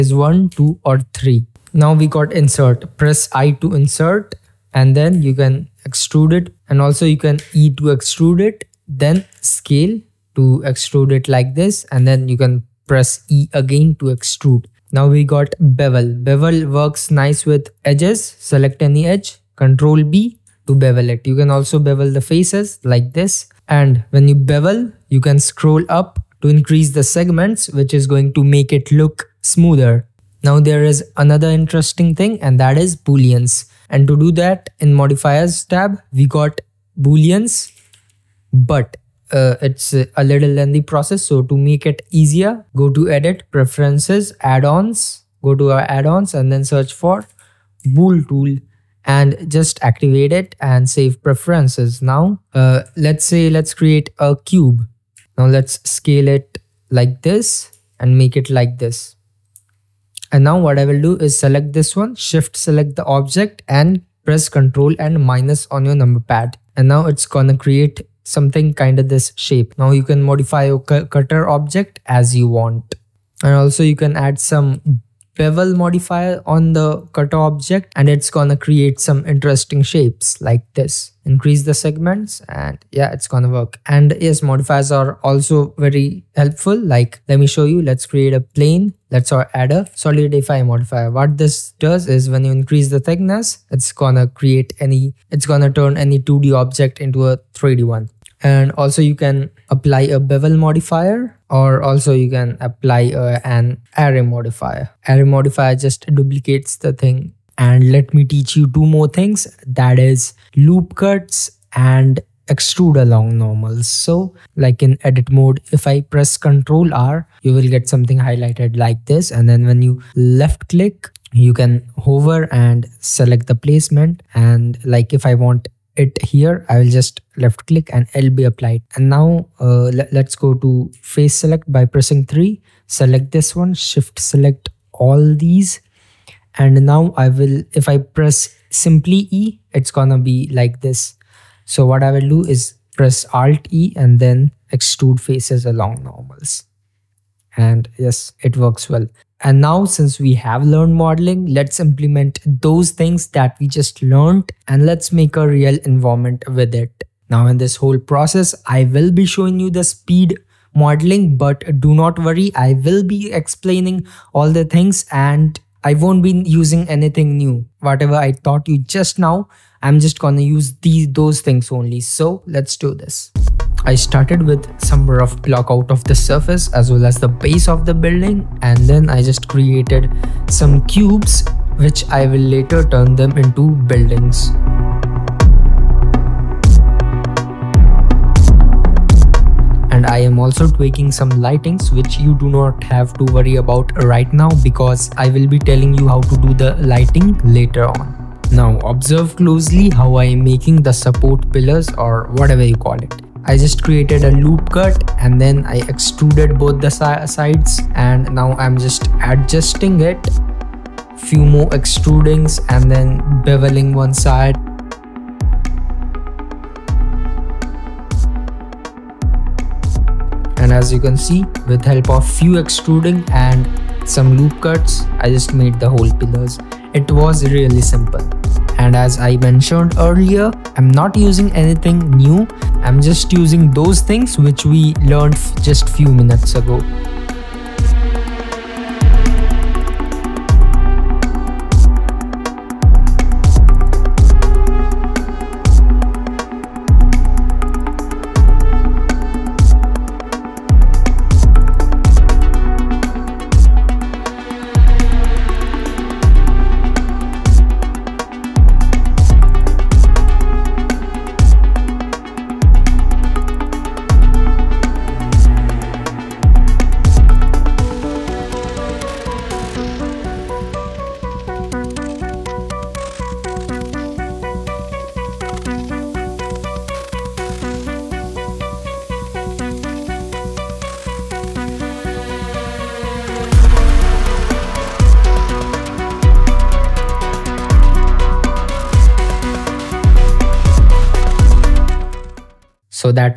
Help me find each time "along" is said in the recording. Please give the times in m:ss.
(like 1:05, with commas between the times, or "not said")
1:53, 2:25.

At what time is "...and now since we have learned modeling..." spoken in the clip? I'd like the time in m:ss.
2:29.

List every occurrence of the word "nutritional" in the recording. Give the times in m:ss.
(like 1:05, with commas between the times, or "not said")
not said.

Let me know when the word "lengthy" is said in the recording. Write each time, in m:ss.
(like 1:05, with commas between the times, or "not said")
0:40.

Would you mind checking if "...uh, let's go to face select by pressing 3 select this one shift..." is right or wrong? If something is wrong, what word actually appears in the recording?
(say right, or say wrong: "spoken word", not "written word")
right.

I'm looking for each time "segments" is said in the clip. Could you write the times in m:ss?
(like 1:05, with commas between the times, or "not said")
0:27, 1:21.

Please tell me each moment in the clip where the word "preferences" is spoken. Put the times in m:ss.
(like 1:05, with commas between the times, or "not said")
0:43, 0:51.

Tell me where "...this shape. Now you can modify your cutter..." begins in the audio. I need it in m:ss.
1:09.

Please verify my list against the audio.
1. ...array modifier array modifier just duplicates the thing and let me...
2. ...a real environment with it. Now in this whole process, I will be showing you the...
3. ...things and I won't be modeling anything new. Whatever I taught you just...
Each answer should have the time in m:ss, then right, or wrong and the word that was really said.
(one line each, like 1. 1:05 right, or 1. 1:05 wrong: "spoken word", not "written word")
1. 1:43 right
2. 2:35 right
3. 2:44 wrong: "using", not "modeling".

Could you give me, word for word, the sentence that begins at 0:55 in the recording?
Now let's scale it like this and make it like this.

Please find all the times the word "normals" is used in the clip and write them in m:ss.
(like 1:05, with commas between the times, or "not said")
1:53, 2:26.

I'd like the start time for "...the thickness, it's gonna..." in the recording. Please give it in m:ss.
1:32.